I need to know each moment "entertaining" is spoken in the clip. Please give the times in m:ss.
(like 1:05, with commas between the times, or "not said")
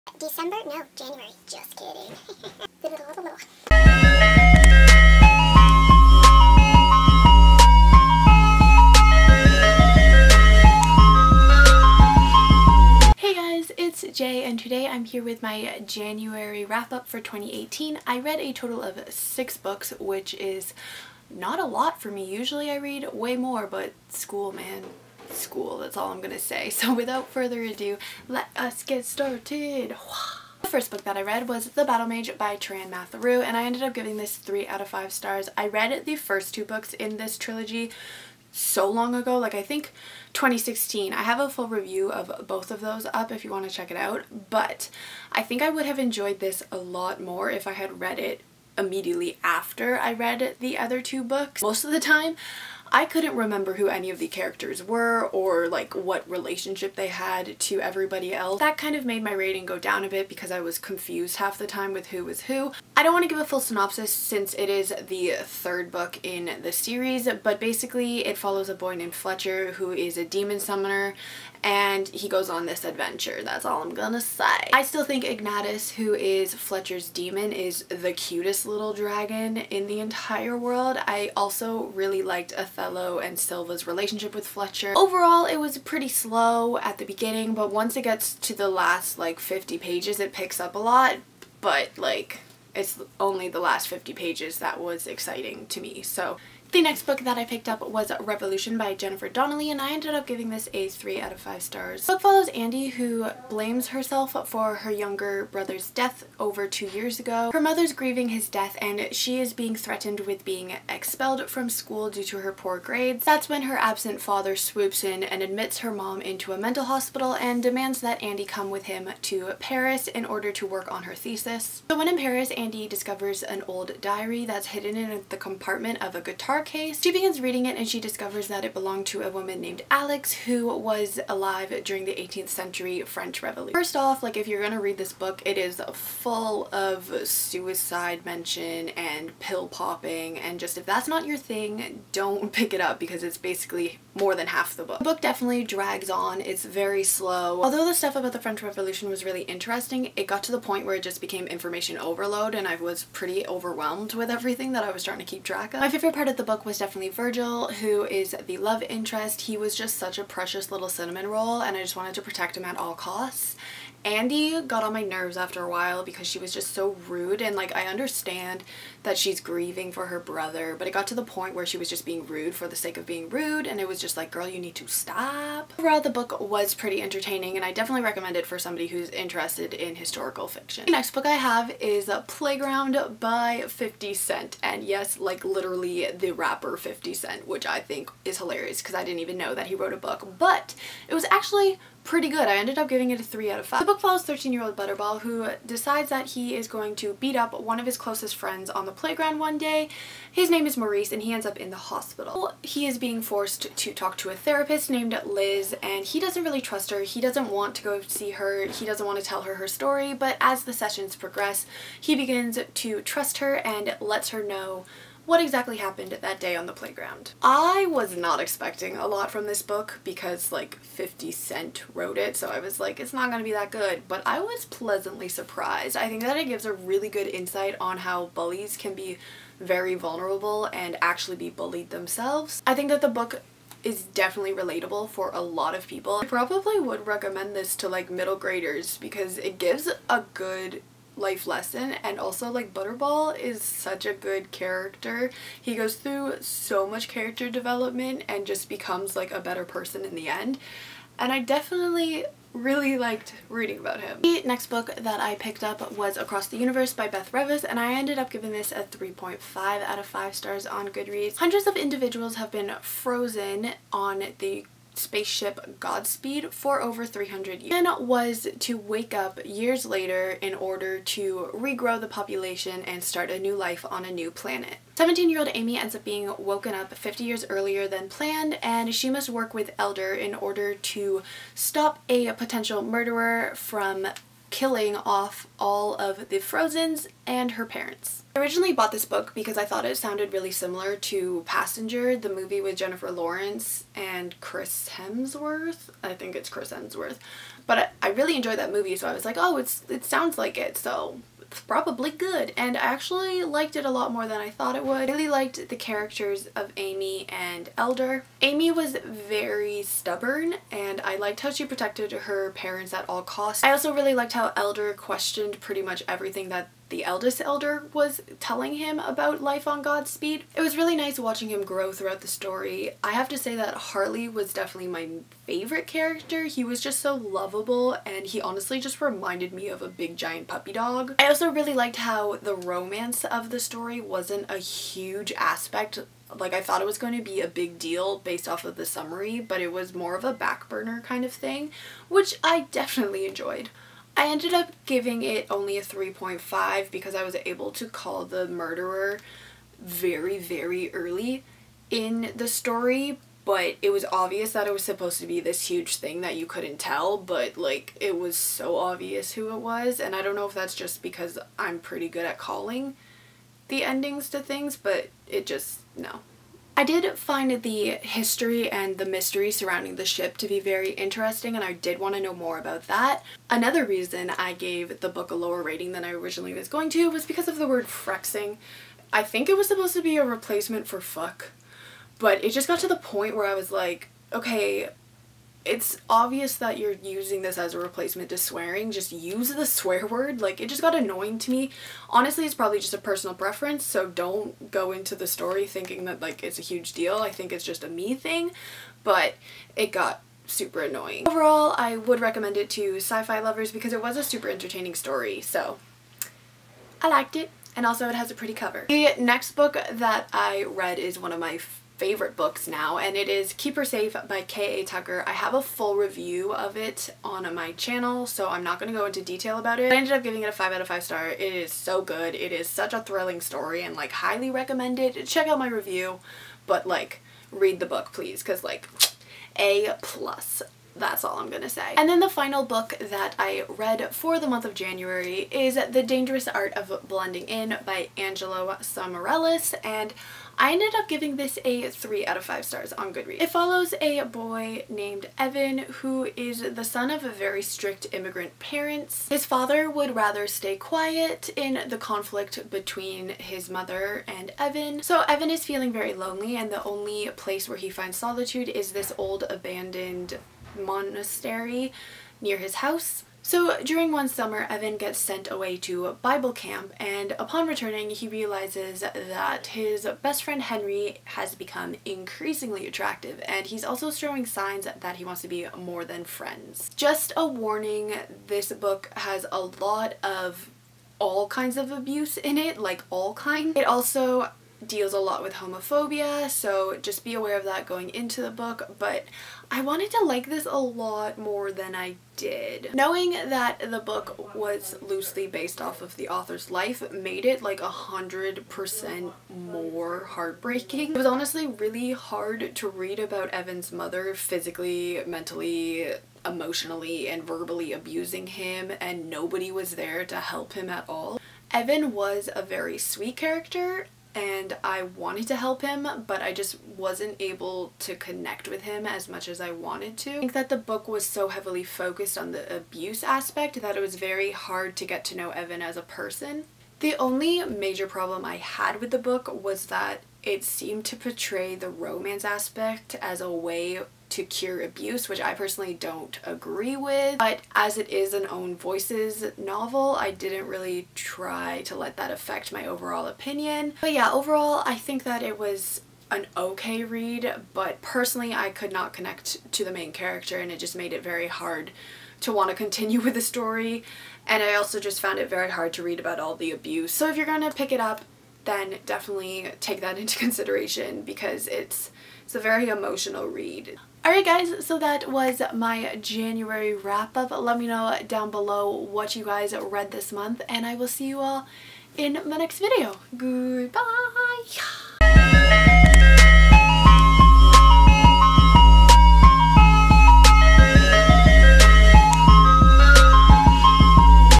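2:57, 6:44.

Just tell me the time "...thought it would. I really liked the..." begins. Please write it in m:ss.
5:04.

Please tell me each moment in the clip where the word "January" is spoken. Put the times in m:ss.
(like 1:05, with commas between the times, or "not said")
0:00, 0:15, 7:14, 9:26.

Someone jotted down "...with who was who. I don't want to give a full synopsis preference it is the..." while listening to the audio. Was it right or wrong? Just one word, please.
wrong.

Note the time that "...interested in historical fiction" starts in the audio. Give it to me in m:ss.
2:59.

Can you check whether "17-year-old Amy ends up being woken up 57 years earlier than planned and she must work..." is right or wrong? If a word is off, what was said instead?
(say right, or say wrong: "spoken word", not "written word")
wrong: "50", not "57".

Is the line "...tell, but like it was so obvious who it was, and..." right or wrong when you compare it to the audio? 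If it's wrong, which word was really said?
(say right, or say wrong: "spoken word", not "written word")
right.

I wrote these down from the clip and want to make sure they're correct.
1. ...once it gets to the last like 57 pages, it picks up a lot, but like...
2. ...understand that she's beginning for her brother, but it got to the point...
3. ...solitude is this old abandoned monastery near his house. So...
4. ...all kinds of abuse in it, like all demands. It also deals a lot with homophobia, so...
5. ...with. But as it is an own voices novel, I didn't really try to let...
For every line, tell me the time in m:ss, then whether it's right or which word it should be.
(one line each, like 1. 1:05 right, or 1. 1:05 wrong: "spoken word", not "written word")
1. 1:27 wrong: "50", not "57"
2. 2:47 wrong: "grieving", not "beginning"
3. 7:38 right
4. 8:01 wrong: "kinds", not "demands"
5. 8:56 right.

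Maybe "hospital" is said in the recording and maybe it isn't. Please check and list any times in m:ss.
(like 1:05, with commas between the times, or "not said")
1:56, 3:21.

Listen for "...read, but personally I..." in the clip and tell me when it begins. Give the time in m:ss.
9:07.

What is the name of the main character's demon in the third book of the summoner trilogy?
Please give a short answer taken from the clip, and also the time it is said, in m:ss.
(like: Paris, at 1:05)
Ignatius, at 1:15.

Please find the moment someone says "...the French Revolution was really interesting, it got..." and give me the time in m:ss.
2:28.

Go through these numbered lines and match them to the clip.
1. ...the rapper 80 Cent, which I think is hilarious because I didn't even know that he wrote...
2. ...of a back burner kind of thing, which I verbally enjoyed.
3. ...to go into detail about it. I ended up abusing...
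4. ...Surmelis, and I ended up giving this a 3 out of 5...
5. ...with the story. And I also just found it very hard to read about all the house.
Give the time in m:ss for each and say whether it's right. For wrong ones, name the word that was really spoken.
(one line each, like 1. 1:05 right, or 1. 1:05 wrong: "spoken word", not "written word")
1. 3:06 wrong: "50", not "80"
2. 5:40 wrong: "definitely", not "verbally"
3. 6:58 wrong: "giving", not "abusing"
4. 7:18 right
5. 9:13 wrong: "abuse", not "house".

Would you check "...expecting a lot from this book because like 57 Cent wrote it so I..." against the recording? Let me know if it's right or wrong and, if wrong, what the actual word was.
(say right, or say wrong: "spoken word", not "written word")
wrong: "50", not "57".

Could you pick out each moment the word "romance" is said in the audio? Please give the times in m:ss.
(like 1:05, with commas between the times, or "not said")
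5:32, 8:51.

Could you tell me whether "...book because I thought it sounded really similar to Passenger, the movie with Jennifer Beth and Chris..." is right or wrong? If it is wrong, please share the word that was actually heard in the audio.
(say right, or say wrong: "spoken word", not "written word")
wrong: "Lawrence", not "Beth".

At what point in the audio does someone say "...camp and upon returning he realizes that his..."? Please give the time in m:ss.
7:46.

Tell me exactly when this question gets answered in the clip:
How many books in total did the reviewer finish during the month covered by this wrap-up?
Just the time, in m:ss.
0:19.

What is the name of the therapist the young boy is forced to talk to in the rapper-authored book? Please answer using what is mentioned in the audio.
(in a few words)
Liz.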